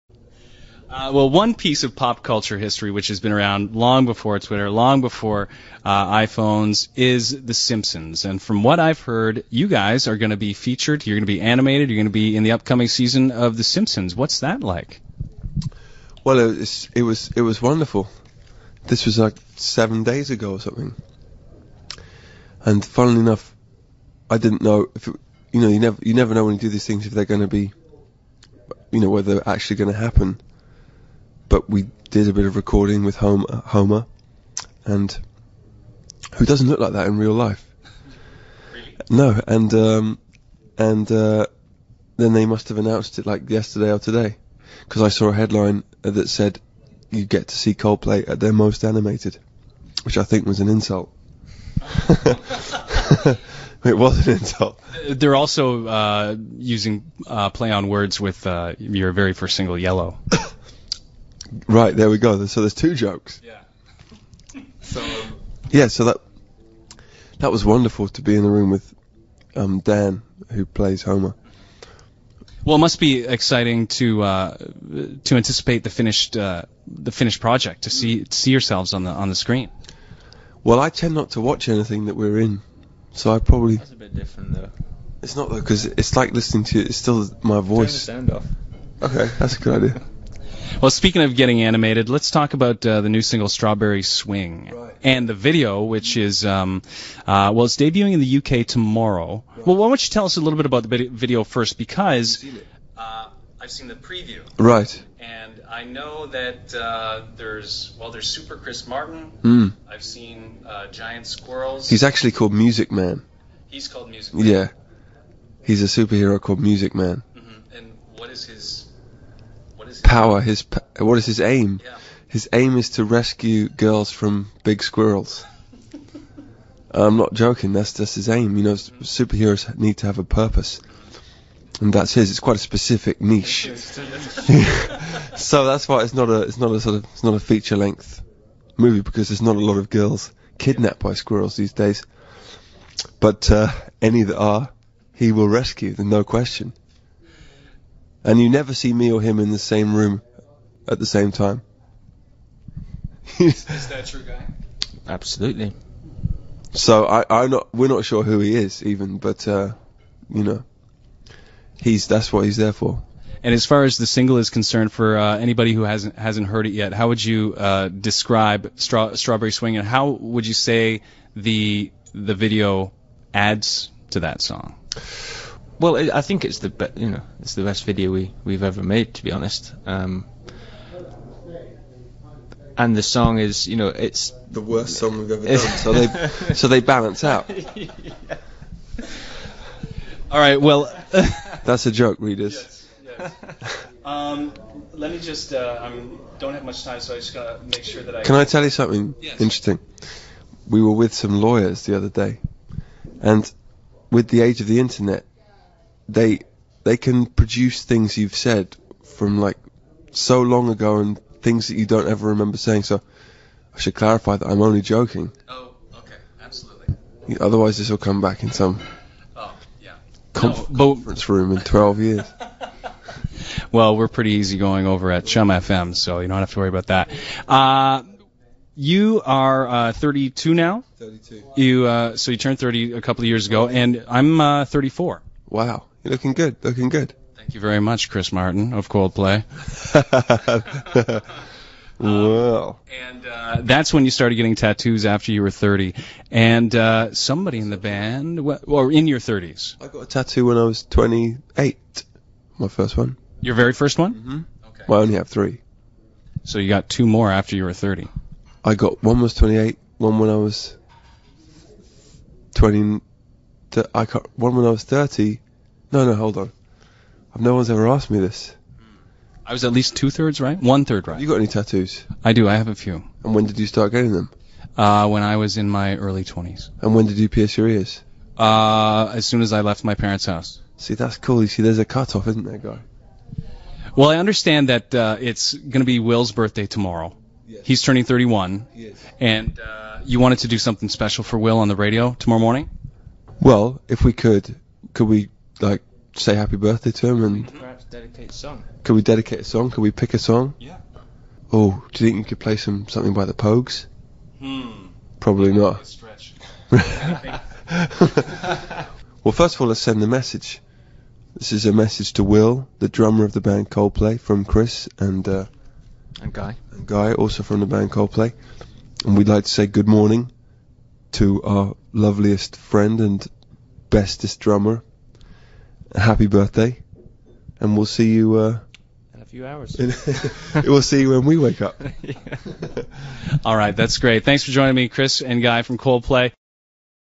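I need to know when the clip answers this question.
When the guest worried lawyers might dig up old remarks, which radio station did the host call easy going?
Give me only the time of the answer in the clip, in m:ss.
3:45.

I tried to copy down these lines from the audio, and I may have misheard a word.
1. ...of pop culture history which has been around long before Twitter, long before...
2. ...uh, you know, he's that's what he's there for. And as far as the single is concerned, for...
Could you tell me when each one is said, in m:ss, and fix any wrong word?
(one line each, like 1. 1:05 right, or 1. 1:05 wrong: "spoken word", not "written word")
1. 0:01 right
2. 2:39 right.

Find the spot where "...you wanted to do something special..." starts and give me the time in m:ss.
4:50.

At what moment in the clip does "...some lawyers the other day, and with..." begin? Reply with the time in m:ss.
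3:21.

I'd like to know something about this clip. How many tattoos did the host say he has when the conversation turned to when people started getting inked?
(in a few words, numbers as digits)
3.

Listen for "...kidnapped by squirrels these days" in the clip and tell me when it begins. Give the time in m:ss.
2:20.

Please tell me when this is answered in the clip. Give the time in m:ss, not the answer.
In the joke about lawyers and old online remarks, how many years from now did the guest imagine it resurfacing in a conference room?
3:41.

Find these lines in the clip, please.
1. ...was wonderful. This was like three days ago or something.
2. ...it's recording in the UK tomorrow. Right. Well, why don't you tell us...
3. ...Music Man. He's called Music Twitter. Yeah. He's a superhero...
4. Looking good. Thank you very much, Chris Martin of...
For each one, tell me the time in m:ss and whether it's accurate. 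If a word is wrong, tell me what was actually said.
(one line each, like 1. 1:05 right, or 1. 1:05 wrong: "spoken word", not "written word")
1. 0:17 wrong: "seven", not "three"
2. 1:37 wrong: "debuting", not "recording"
3. 1:52 wrong: "Man", not "Twitter"
4. 3:56 right.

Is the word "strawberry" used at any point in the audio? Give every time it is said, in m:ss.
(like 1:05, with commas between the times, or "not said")
1:33, 2:48.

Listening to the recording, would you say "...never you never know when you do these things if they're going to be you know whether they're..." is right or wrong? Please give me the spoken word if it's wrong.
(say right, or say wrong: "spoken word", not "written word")
right.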